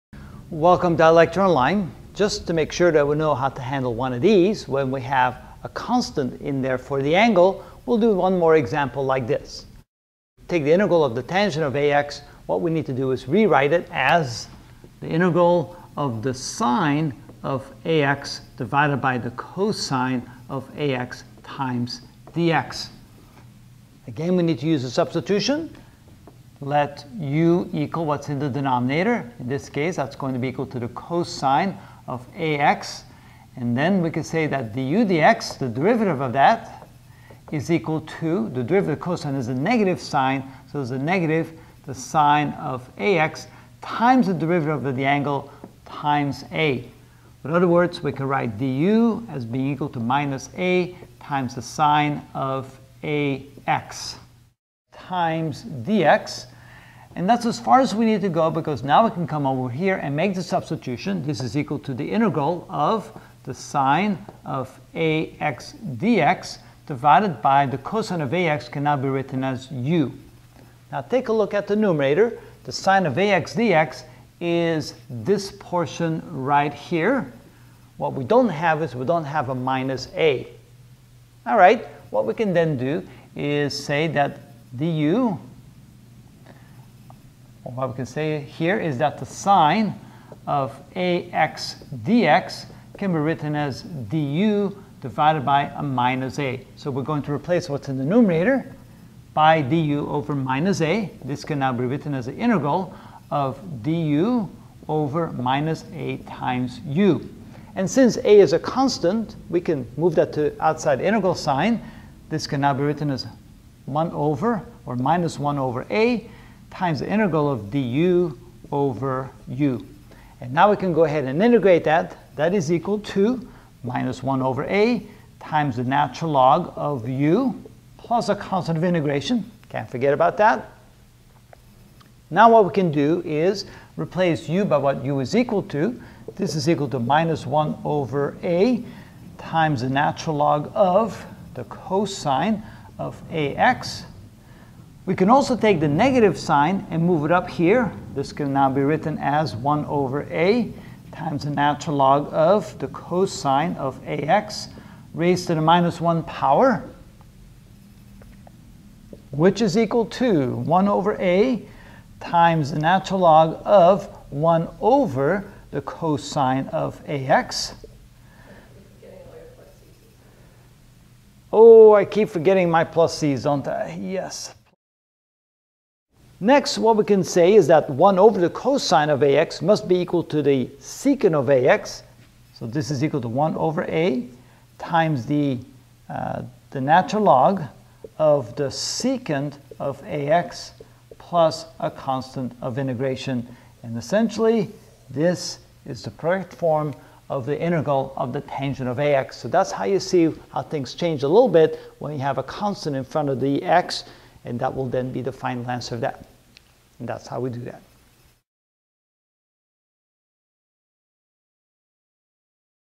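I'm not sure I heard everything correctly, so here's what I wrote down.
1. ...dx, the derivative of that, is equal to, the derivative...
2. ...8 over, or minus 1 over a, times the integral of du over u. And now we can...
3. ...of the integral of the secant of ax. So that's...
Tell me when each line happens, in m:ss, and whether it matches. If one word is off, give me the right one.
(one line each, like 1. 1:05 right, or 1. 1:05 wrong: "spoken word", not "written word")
1. 0:35 right
2. 1:53 wrong: "1", not "8"
3. 3:17 wrong: "tangent", not "secant".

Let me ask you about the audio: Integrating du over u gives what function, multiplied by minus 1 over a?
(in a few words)
natural log of u.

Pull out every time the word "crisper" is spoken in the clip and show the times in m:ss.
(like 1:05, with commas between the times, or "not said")
not said.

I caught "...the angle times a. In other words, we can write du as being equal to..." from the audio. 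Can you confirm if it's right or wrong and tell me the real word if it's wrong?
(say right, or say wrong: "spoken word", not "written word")
right.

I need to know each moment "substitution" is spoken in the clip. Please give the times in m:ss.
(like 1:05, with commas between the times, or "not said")
0:24, 1:00.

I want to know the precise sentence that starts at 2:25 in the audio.
We can also take the negative sign and move it up here.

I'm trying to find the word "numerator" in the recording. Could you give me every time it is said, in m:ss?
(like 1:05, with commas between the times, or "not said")
1:11, 1:38.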